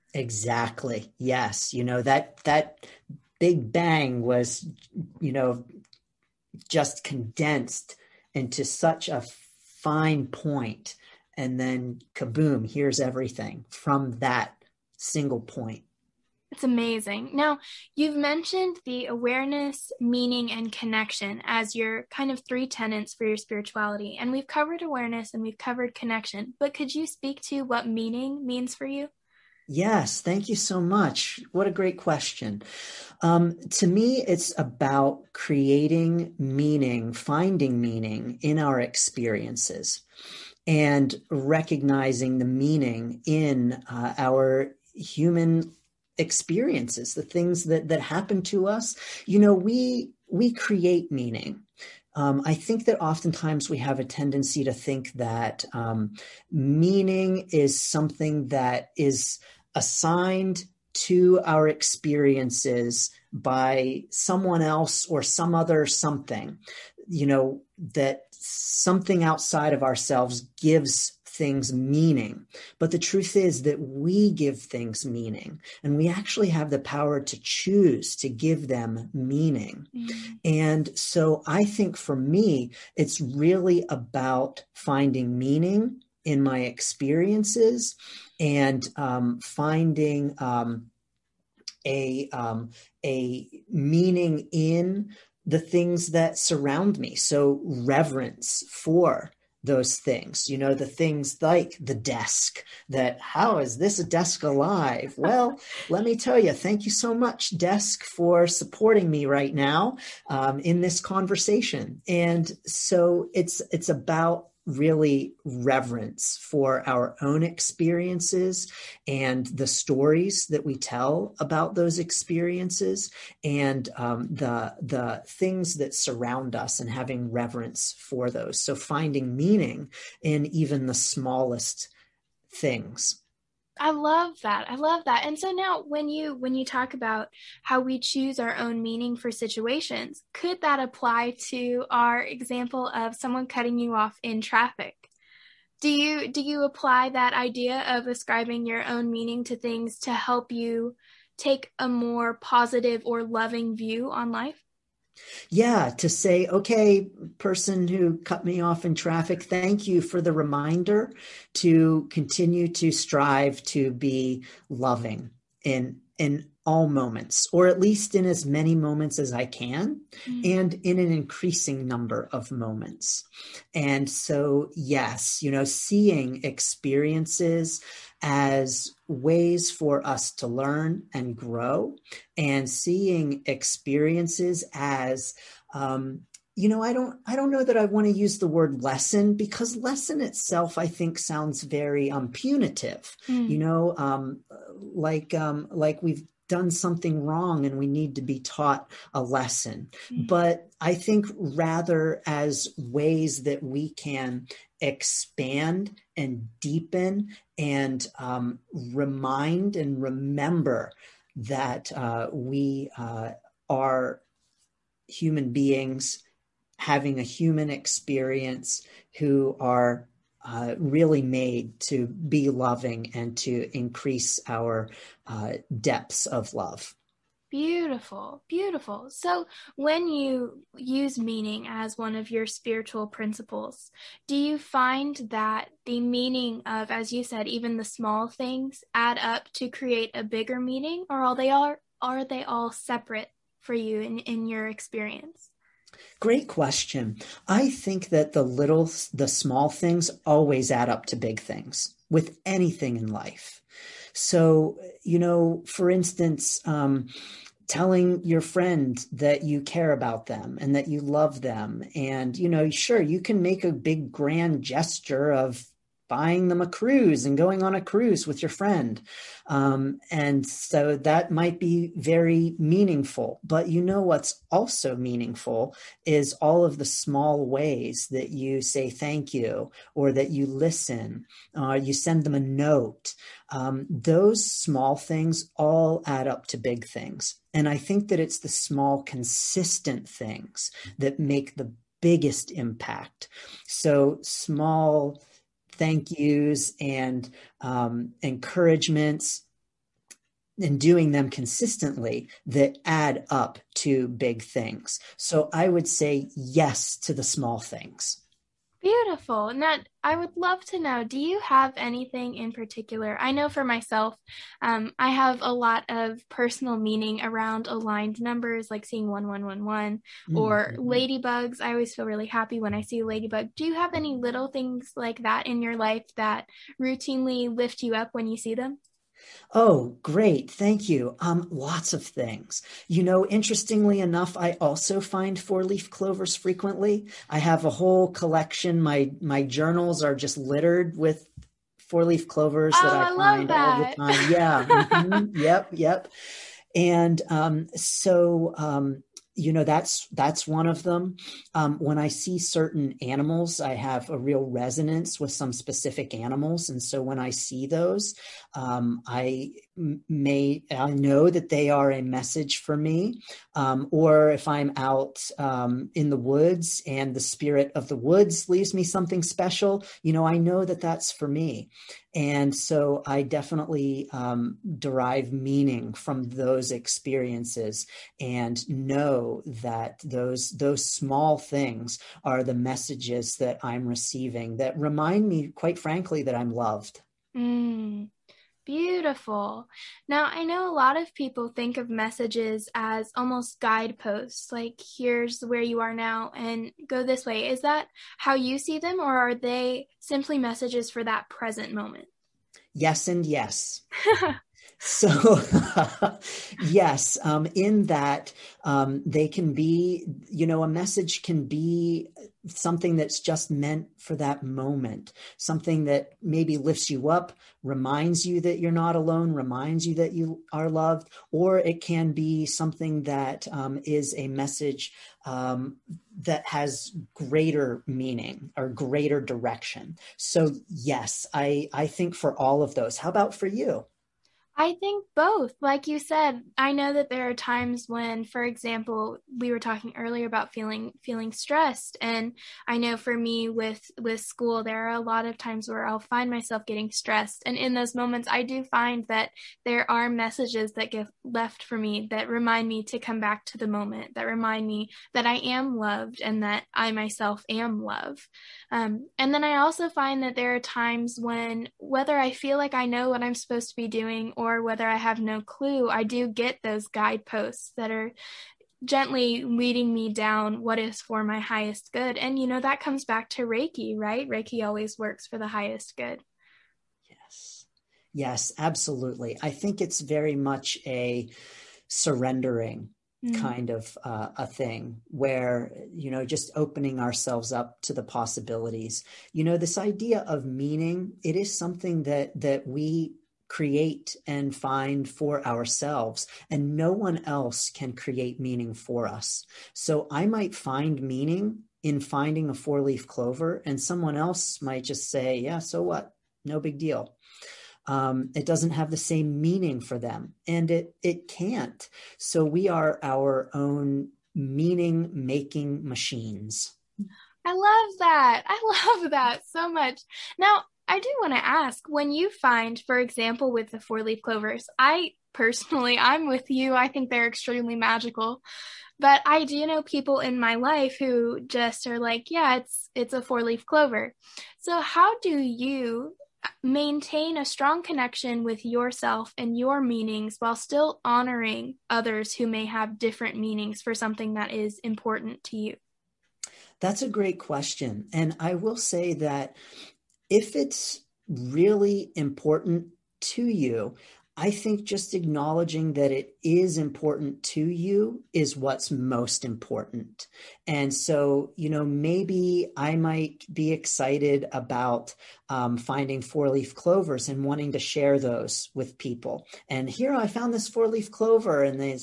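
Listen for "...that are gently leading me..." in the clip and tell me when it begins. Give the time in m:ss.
7:47.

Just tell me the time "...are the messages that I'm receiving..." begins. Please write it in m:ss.
6:22.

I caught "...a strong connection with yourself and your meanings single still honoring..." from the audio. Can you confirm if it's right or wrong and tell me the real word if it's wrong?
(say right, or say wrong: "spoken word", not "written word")
wrong: "while", not "single".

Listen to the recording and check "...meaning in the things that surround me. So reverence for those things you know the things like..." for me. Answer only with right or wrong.
right.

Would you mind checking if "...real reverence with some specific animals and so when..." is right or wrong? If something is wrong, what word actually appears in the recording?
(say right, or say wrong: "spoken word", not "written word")
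wrong: "resonance", not "reverence".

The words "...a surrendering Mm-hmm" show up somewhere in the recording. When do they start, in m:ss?
8:00.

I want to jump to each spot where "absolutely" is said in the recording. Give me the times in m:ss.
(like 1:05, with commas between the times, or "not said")
7:58.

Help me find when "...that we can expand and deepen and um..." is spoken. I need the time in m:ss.
3:23.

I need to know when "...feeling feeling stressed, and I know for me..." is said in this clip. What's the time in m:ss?
7:20.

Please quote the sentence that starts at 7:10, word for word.
So, yes, I, I think for all of those.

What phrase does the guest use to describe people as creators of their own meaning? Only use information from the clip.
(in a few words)
Meaning making machines.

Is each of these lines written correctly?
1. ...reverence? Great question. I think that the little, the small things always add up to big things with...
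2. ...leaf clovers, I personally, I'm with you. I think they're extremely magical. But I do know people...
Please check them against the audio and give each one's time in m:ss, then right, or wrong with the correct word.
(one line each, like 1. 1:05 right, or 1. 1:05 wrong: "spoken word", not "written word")
1. 4:04 wrong: "experience", not "reverence"
2. 8:44 right.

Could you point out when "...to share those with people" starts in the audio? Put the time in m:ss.
9:27.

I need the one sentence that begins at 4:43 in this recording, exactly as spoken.
Um, those small things all add up to big things.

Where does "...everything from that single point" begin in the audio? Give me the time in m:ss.
0:12.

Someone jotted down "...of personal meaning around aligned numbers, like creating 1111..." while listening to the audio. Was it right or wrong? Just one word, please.
wrong.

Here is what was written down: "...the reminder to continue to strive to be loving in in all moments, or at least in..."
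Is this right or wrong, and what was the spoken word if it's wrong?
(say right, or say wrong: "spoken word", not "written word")
right.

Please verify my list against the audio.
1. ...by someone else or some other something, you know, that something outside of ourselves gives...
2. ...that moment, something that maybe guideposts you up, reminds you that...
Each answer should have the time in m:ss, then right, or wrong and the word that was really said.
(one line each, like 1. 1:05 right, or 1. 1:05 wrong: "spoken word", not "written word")
1. 1:03 right
2. 6:54 wrong: "lifts", not "guideposts".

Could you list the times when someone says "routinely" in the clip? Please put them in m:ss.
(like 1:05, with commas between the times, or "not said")
5:26.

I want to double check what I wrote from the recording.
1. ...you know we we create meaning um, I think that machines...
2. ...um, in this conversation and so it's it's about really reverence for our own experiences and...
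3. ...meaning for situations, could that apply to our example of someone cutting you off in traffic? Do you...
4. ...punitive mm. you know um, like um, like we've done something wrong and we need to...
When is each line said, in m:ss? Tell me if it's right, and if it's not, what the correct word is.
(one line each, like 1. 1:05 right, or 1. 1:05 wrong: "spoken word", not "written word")
1. 0:49 wrong: "oftentimes", not "machines"
2. 1:50 right
3. 2:18 right
4. 3:12 right.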